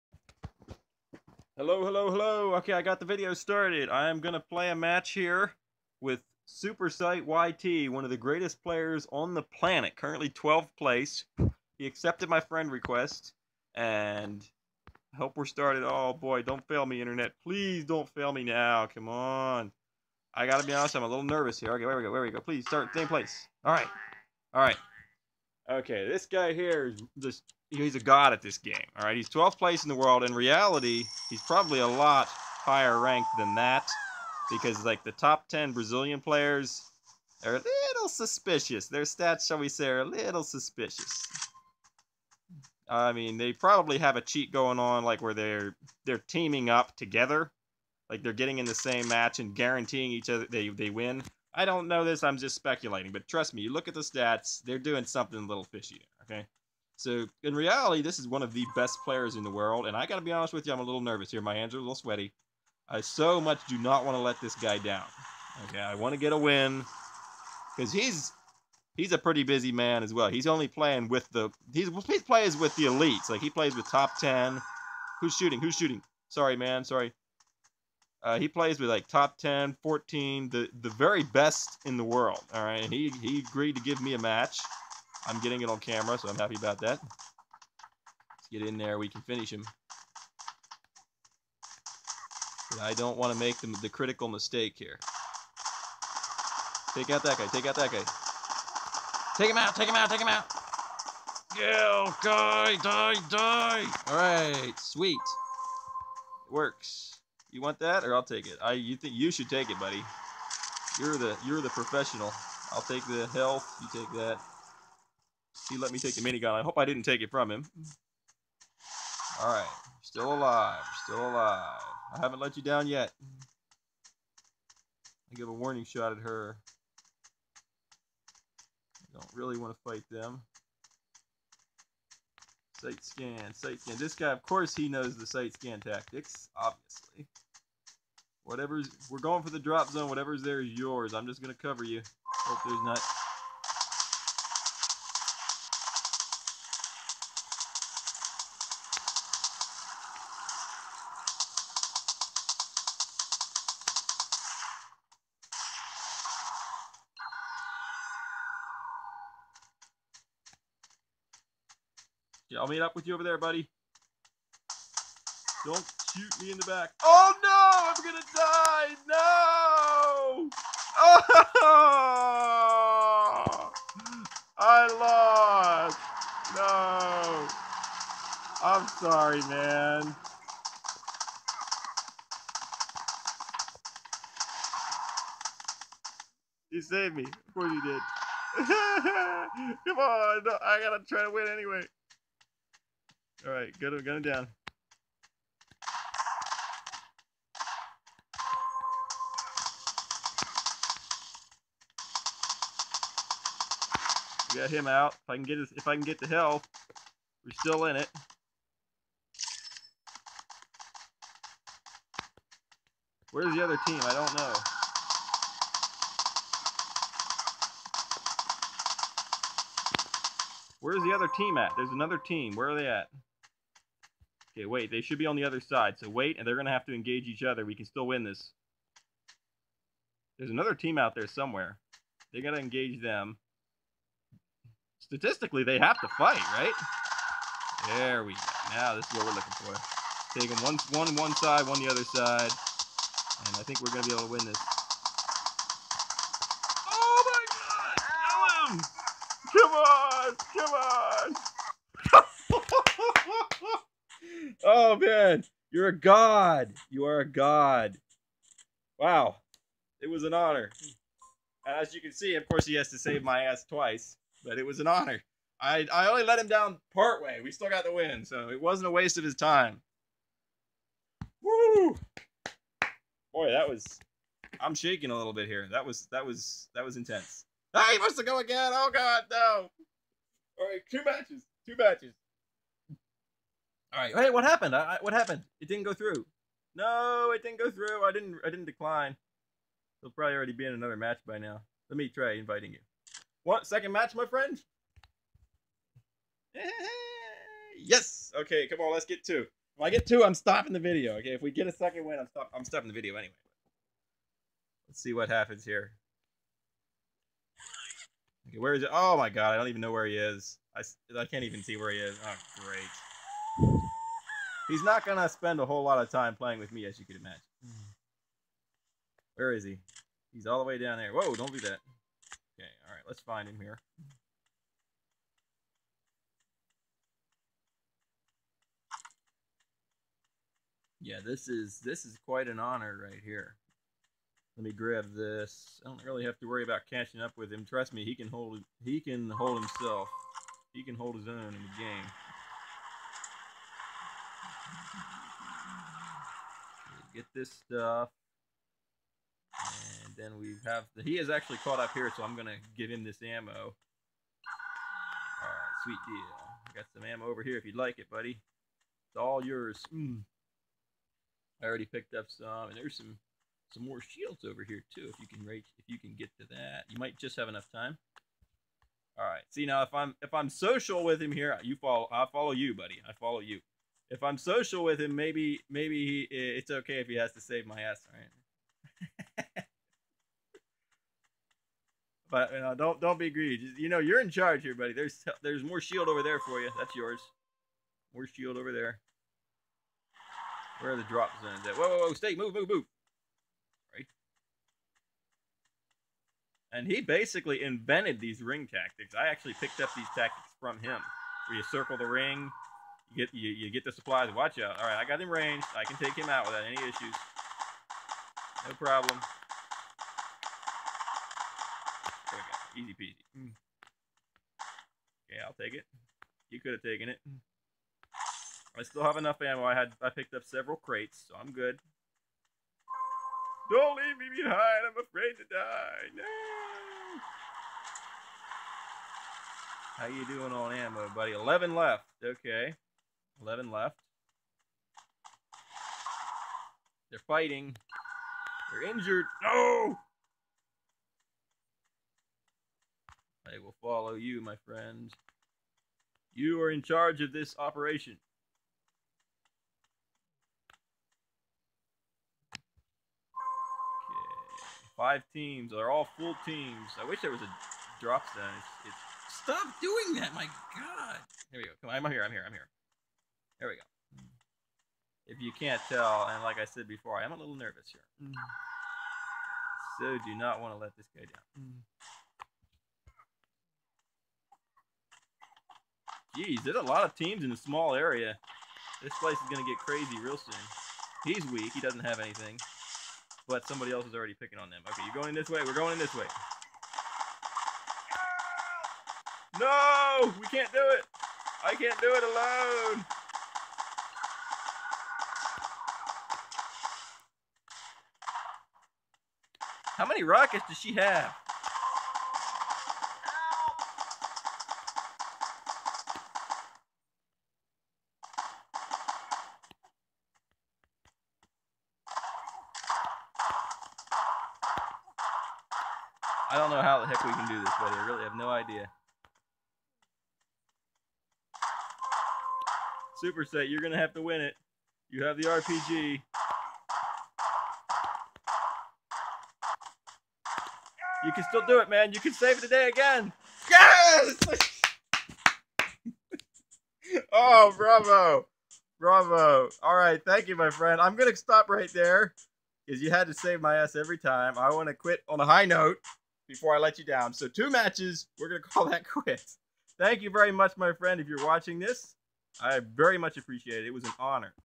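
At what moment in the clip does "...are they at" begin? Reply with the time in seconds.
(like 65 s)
222 s.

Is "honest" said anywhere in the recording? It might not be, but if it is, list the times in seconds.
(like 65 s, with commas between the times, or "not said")
20 s, 60 s.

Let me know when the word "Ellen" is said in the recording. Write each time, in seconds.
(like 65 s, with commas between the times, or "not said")
248 s.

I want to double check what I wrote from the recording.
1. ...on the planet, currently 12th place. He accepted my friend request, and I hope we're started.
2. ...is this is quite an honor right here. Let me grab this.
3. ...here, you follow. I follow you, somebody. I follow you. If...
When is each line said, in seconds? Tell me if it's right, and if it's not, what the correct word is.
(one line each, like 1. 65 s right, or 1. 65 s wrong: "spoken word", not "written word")
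1. 9 s right
2. 331 s right
3. 371 s wrong: "buddy", not "somebody".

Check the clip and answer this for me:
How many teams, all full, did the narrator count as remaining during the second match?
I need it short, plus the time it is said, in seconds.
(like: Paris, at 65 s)
5, at 454 s.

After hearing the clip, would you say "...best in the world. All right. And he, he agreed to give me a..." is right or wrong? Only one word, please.
right.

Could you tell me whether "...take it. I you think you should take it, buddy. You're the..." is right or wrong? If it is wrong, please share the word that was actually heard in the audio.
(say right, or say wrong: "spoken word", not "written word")
right.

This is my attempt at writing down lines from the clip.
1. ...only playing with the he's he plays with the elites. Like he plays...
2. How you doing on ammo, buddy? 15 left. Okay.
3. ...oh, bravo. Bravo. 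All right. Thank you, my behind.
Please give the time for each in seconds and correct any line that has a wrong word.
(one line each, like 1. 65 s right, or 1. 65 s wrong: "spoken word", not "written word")
1. 70 s right
2. 429 s wrong: "11", not "15"
3. 537 s wrong: "friend", not "behind".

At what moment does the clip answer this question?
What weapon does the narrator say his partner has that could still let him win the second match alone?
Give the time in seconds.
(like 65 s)
525 s.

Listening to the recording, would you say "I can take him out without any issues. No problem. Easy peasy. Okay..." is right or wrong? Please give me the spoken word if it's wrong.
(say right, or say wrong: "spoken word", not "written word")
right.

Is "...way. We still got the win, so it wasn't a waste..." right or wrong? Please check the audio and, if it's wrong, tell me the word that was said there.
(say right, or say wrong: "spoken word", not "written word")
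right.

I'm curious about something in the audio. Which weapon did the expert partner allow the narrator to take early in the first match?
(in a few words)
Minigun.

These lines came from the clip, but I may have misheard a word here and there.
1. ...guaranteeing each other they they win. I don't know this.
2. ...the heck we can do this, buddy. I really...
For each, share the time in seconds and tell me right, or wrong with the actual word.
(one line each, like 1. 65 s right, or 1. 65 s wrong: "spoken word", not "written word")
1. 49 s right
2. 516 s right.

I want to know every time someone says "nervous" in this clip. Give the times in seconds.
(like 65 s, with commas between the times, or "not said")
21 s, 61 s, 467 s.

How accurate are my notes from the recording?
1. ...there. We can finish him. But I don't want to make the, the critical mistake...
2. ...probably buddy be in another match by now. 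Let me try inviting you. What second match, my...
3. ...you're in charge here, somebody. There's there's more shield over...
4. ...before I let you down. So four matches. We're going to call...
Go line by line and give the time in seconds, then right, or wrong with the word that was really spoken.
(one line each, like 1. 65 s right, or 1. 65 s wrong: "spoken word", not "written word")
1. 88 s right
2. 290 s wrong: "already", not "buddy"
3. 383 s wrong: "buddy", not "somebody"
4. 546 s wrong: "two", not "four".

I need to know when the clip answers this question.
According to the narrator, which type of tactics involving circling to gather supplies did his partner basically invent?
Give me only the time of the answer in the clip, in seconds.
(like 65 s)
398 s.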